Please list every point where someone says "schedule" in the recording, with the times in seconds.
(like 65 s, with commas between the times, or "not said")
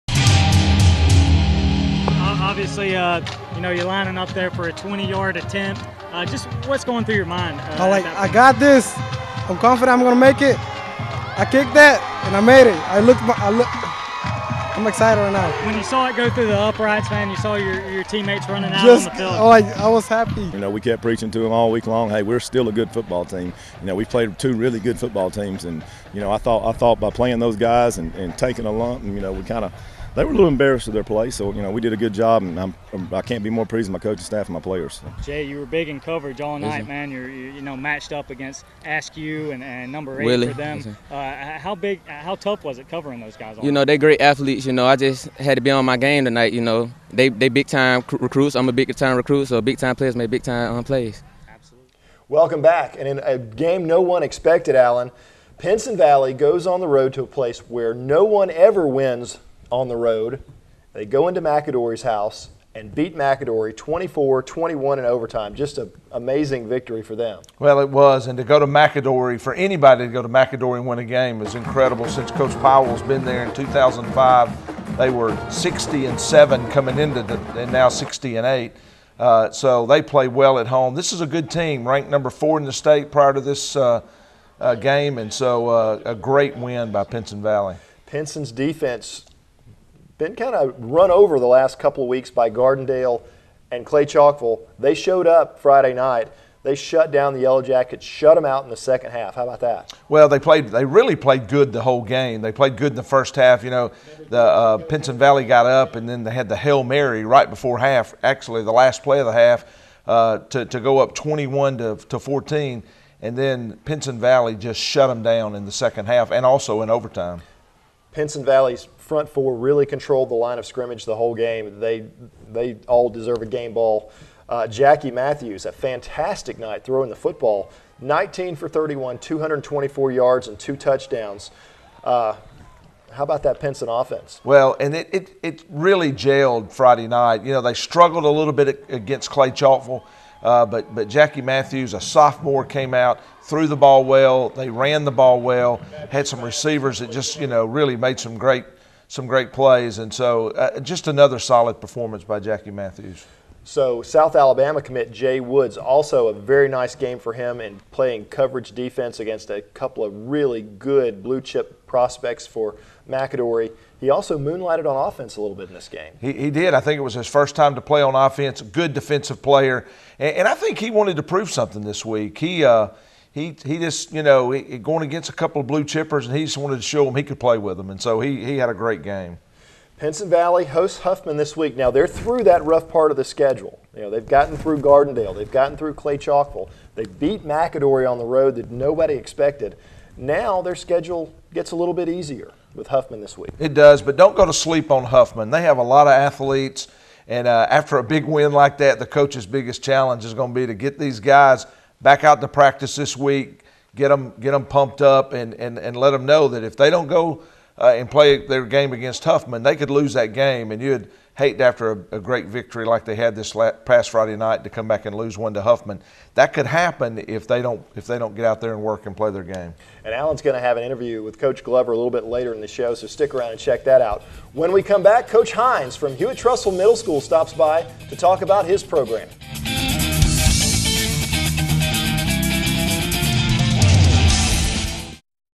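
183 s, 190 s.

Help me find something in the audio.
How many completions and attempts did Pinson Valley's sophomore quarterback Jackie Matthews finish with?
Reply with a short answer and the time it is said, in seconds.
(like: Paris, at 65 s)
19 for 31, at 128 s.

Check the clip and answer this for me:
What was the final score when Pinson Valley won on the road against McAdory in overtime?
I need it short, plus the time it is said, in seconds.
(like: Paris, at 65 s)
24-21, at 63 s.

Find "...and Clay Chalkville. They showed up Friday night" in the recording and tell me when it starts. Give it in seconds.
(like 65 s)
93 s.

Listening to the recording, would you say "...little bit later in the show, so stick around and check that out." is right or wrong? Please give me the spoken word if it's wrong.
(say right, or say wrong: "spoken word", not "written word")
right.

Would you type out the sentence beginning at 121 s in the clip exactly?
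They they all deserve a game ball.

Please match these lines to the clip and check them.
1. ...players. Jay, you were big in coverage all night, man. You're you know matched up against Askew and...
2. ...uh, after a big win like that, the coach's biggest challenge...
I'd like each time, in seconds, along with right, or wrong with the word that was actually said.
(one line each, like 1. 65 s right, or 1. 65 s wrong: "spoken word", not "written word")
1. 34 s right
2. 197 s right.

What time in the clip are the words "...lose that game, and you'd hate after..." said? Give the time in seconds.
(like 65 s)
209 s.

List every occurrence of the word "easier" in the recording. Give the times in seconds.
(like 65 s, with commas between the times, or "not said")
192 s.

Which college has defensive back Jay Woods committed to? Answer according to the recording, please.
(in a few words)
South Alabama.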